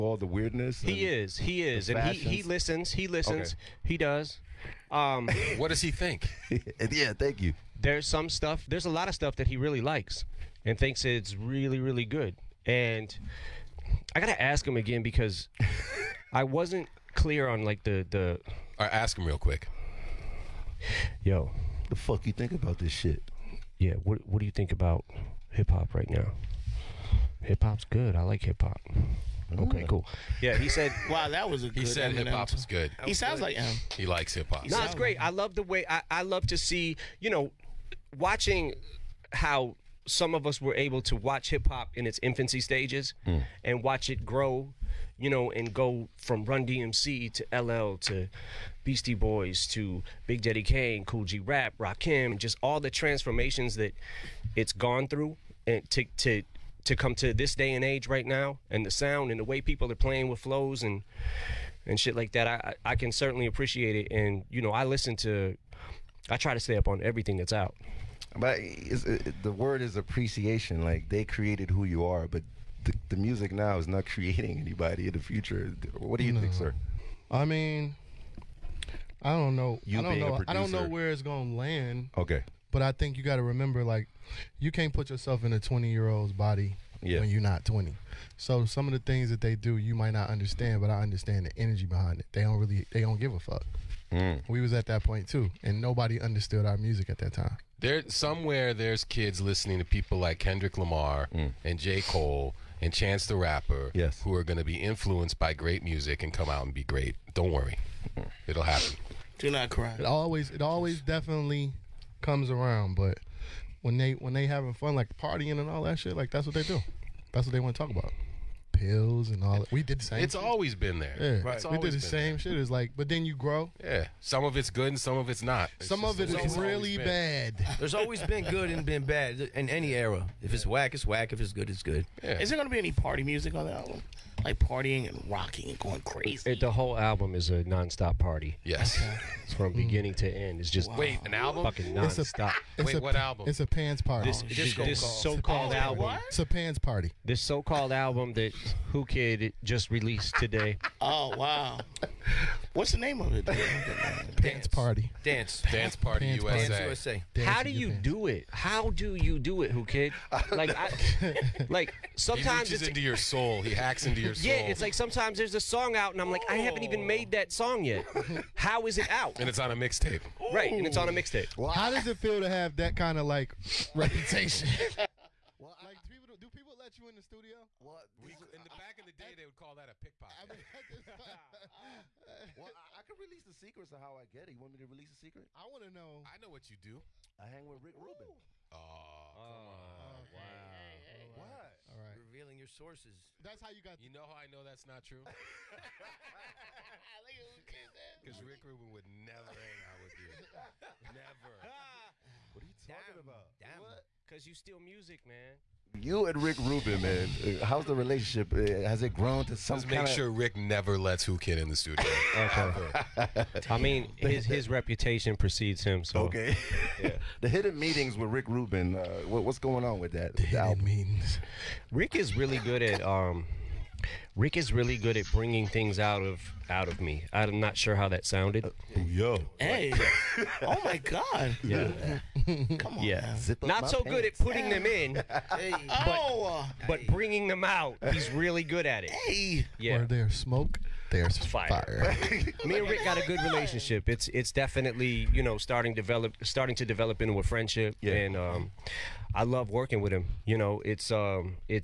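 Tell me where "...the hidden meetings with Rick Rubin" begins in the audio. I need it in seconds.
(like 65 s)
217 s.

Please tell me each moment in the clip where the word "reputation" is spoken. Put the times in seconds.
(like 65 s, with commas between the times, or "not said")
173 s, 214 s.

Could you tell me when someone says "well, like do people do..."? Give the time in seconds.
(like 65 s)
175 s.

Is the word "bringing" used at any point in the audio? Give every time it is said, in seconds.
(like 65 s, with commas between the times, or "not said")
225 s, 237 s.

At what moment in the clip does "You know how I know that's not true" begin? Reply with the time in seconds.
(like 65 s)
193 s.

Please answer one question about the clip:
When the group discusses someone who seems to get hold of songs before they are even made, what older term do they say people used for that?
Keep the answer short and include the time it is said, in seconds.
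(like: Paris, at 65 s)
pickpocket, at 179 s.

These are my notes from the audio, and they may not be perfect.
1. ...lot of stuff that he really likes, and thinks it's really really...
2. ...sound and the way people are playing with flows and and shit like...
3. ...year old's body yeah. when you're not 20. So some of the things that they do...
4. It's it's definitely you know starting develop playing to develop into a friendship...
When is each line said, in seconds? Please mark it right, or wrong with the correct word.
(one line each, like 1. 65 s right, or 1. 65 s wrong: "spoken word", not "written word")
1. 8 s right
2. 58 s right
3. 85 s right
4. 244 s wrong: "starting", not "playing".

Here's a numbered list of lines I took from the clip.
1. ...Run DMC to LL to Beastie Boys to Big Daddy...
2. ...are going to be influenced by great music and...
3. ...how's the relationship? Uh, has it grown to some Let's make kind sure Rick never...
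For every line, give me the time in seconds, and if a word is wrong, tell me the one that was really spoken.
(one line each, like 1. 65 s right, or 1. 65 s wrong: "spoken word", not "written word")
1. 46 s right
2. 104 s right
3. 207 s right.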